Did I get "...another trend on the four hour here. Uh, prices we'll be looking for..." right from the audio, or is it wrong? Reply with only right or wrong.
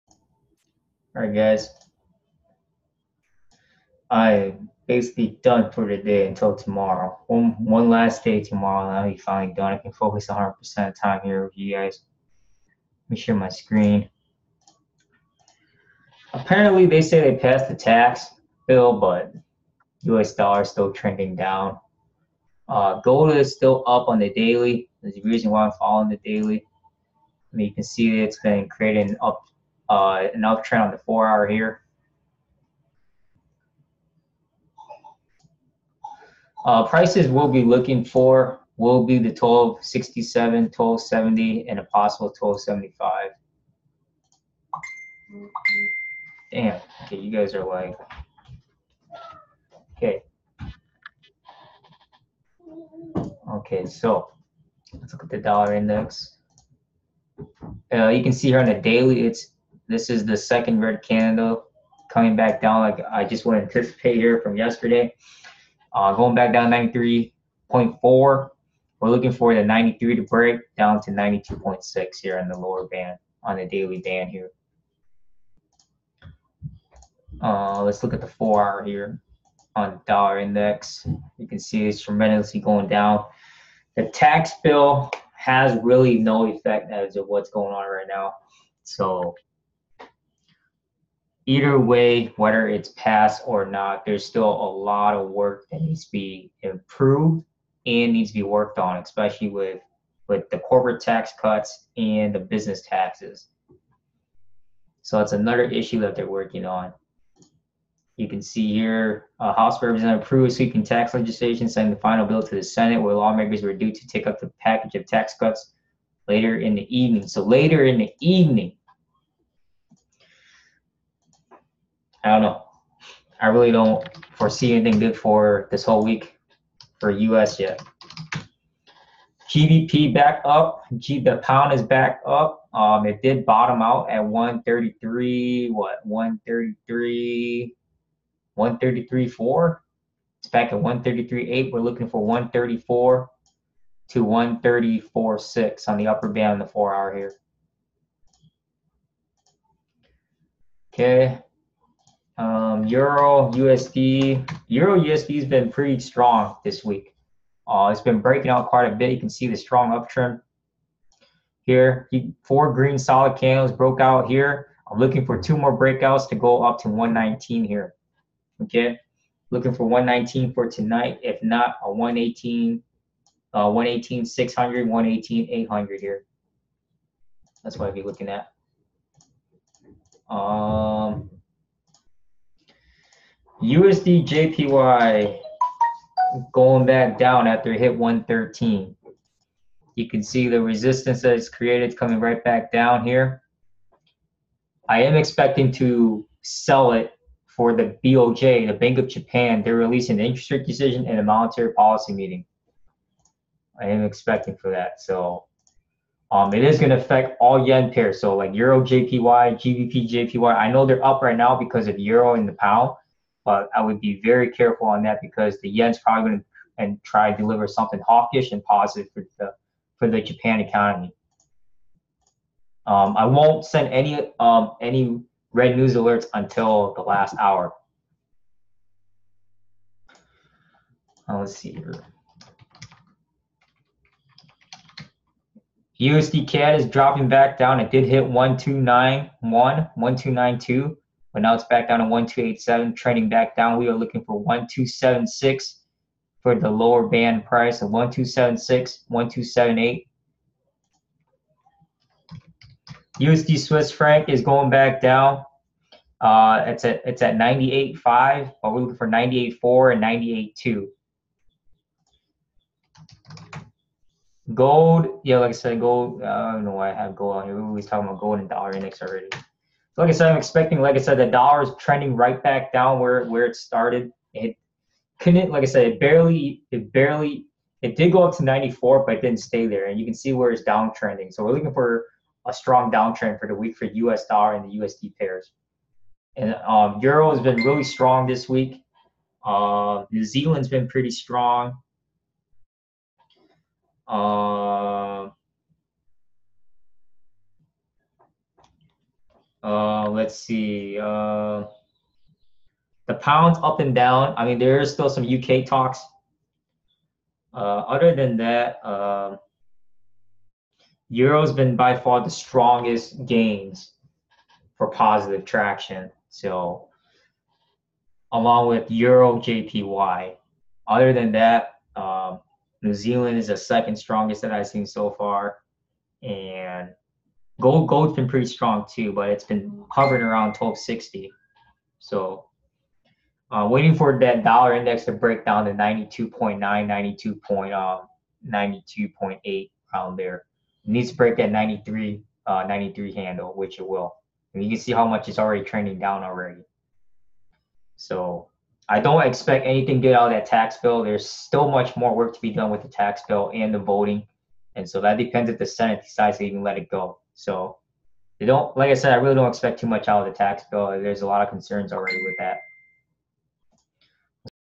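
right.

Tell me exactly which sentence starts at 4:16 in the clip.
Uh, it's at it's at 98.5, but we're looking for 98.4 and 98.2.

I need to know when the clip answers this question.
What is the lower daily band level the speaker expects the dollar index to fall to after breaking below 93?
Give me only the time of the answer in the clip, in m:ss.
1:11.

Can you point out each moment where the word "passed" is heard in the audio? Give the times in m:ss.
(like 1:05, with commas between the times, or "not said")
0:17, 1:32.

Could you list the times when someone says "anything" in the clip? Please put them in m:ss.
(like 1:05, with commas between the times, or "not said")
2:04, 5:49.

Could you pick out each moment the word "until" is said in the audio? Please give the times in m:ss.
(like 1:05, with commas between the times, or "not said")
0:06, 3:46.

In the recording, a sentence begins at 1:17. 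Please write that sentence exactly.
Uh, let's look at the four hour here on dollar index.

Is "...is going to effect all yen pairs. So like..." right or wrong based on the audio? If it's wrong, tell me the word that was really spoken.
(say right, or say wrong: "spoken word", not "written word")
wrong: "affect", not "effect".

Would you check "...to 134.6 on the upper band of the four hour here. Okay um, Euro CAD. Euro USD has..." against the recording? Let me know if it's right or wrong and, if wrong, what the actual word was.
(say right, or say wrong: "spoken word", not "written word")
wrong: "USD", not "CAD".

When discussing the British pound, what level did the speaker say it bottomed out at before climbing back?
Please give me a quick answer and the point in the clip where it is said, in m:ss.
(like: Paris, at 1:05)
133.4, at 2:18.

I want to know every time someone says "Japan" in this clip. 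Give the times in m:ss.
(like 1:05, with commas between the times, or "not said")
3:19, 3:40.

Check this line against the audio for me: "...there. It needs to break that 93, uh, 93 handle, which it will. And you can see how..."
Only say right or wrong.
right.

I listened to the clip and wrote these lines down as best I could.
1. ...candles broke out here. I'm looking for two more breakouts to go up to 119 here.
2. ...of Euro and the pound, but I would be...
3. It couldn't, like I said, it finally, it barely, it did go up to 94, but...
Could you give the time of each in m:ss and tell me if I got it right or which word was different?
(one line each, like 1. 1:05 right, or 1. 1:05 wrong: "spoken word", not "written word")
1. 2:43 right
2. 3:31 right
3. 4:34 wrong: "barely", not "finally".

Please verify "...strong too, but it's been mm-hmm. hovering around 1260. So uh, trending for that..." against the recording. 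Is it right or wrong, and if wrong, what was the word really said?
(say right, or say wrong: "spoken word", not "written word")
wrong: "waiting", not "trending".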